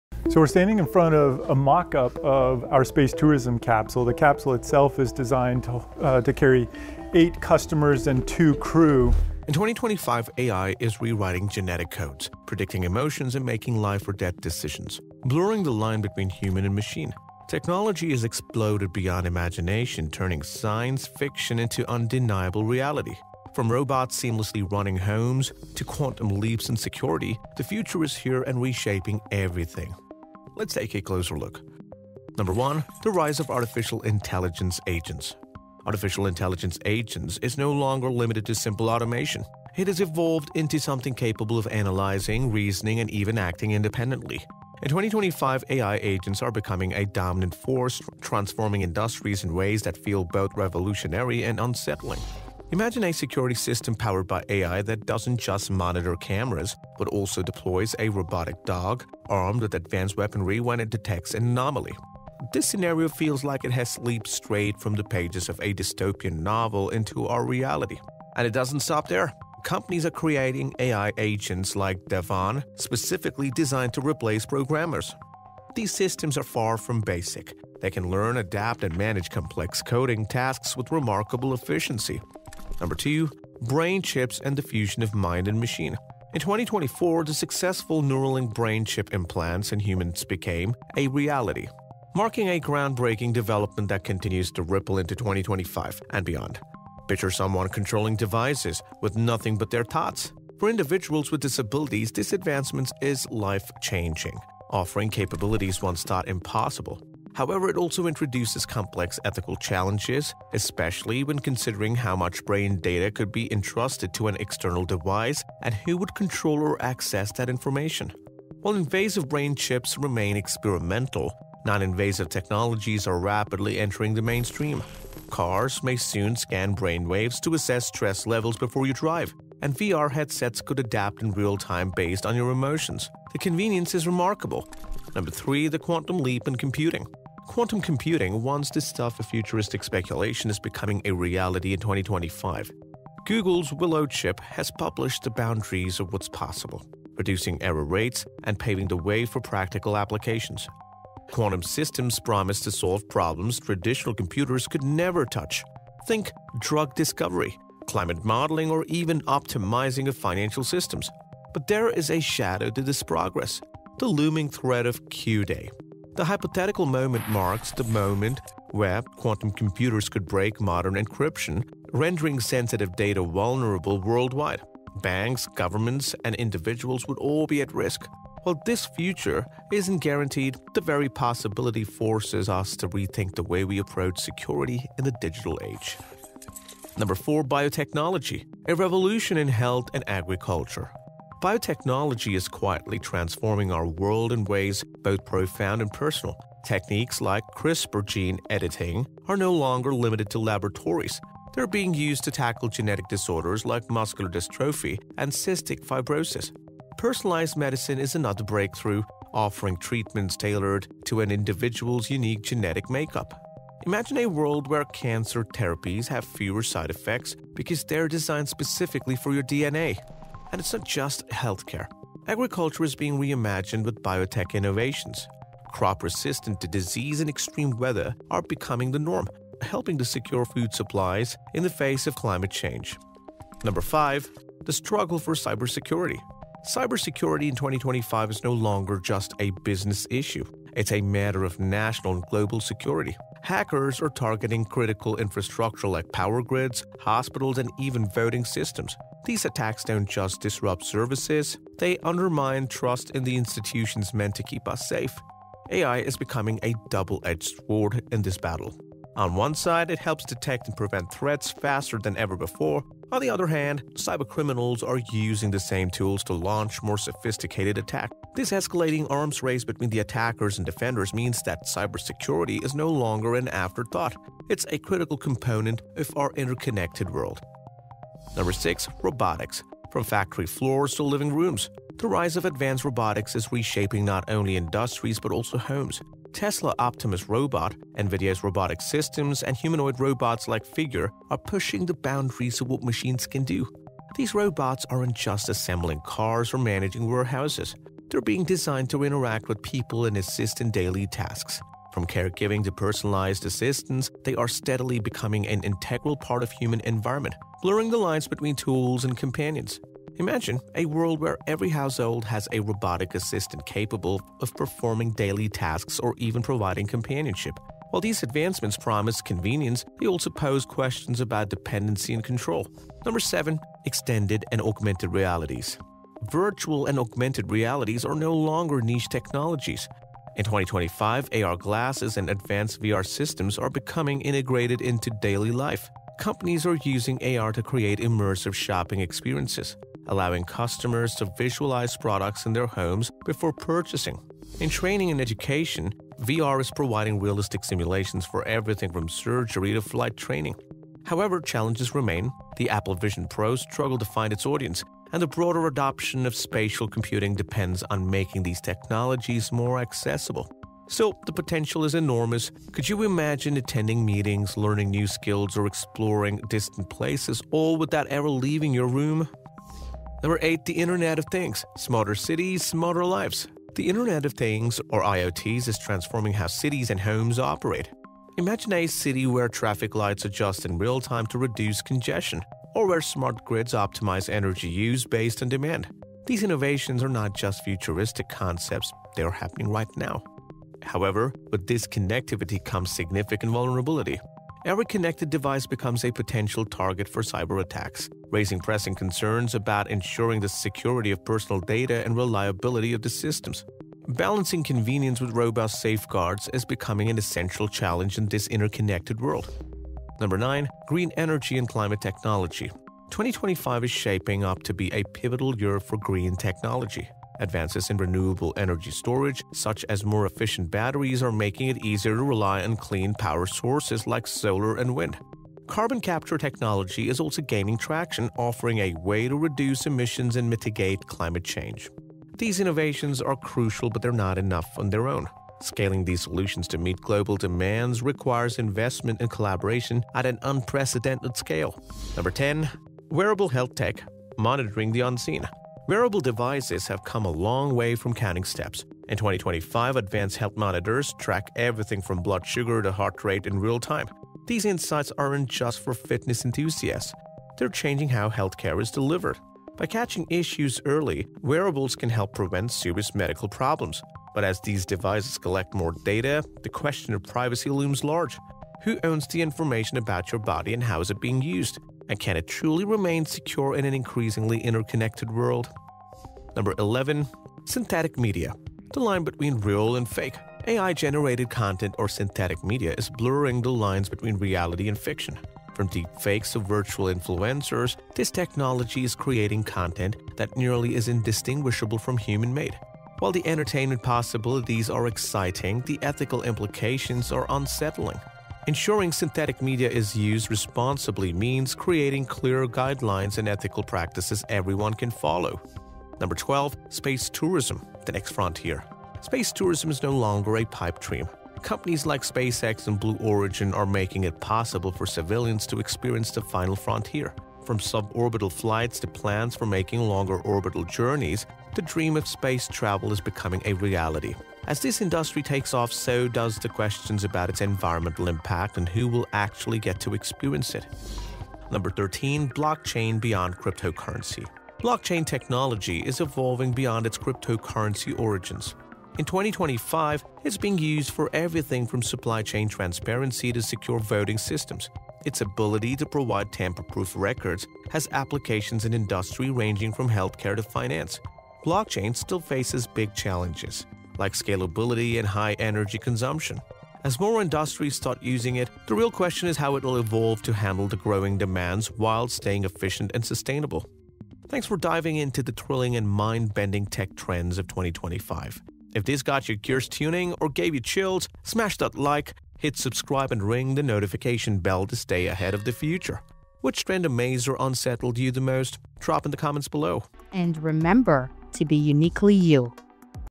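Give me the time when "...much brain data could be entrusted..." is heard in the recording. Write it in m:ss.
1:52.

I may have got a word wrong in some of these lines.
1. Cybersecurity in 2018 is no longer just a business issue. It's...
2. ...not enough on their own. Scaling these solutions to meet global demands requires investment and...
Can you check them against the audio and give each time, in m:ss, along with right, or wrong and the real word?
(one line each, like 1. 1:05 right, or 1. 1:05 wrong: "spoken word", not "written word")
1. 3:56 wrong: "2025", not "2018"
2. 7:14 right.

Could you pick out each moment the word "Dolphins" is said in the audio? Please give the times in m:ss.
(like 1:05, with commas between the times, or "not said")
not said.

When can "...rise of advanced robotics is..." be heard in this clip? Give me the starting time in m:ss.
4:42.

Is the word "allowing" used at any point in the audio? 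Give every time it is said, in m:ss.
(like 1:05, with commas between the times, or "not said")
5:40.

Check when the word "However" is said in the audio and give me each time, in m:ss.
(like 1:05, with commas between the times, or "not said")
1:47, 5:51, 6:30.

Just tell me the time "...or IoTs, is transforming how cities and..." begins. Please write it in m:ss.
6:14.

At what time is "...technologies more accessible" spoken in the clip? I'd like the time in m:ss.
5:58.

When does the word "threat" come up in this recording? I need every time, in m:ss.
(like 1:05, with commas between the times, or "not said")
2:44, 4:21.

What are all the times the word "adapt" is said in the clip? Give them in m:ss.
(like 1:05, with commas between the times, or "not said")
1:18, 2:10.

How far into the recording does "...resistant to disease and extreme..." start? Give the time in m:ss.
3:46.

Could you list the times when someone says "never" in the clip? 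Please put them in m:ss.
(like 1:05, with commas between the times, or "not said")
2:34.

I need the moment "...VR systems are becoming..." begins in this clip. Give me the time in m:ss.
5:32.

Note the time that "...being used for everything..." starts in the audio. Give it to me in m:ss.
9:00.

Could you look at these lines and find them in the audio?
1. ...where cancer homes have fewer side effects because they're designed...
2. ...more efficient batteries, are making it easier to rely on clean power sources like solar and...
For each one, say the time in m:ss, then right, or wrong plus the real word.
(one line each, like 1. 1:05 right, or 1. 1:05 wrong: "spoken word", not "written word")
1. 3:34 wrong: "therapies", not "homes"
2. 7:00 right.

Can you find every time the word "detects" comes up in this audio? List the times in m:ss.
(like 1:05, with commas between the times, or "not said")
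1:00, 4:20.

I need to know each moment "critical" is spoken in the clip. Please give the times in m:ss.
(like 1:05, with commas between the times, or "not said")
4:04, 4:34.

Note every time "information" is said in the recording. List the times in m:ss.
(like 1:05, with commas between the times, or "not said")
1:57, 7:49.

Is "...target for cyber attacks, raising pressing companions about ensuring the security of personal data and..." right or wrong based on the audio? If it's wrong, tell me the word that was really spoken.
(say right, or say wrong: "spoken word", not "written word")
wrong: "concerns", not "companions".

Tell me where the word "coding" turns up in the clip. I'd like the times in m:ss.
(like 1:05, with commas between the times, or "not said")
1:19.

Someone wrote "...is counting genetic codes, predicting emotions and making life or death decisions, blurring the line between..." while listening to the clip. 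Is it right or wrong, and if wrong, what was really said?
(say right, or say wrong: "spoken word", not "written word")
wrong: "rewriting", not "counting".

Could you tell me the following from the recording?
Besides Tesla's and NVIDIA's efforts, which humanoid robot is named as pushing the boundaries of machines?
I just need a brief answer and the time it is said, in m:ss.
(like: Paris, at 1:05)
Figure, at 4:50.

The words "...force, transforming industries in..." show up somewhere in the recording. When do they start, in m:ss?
0:47.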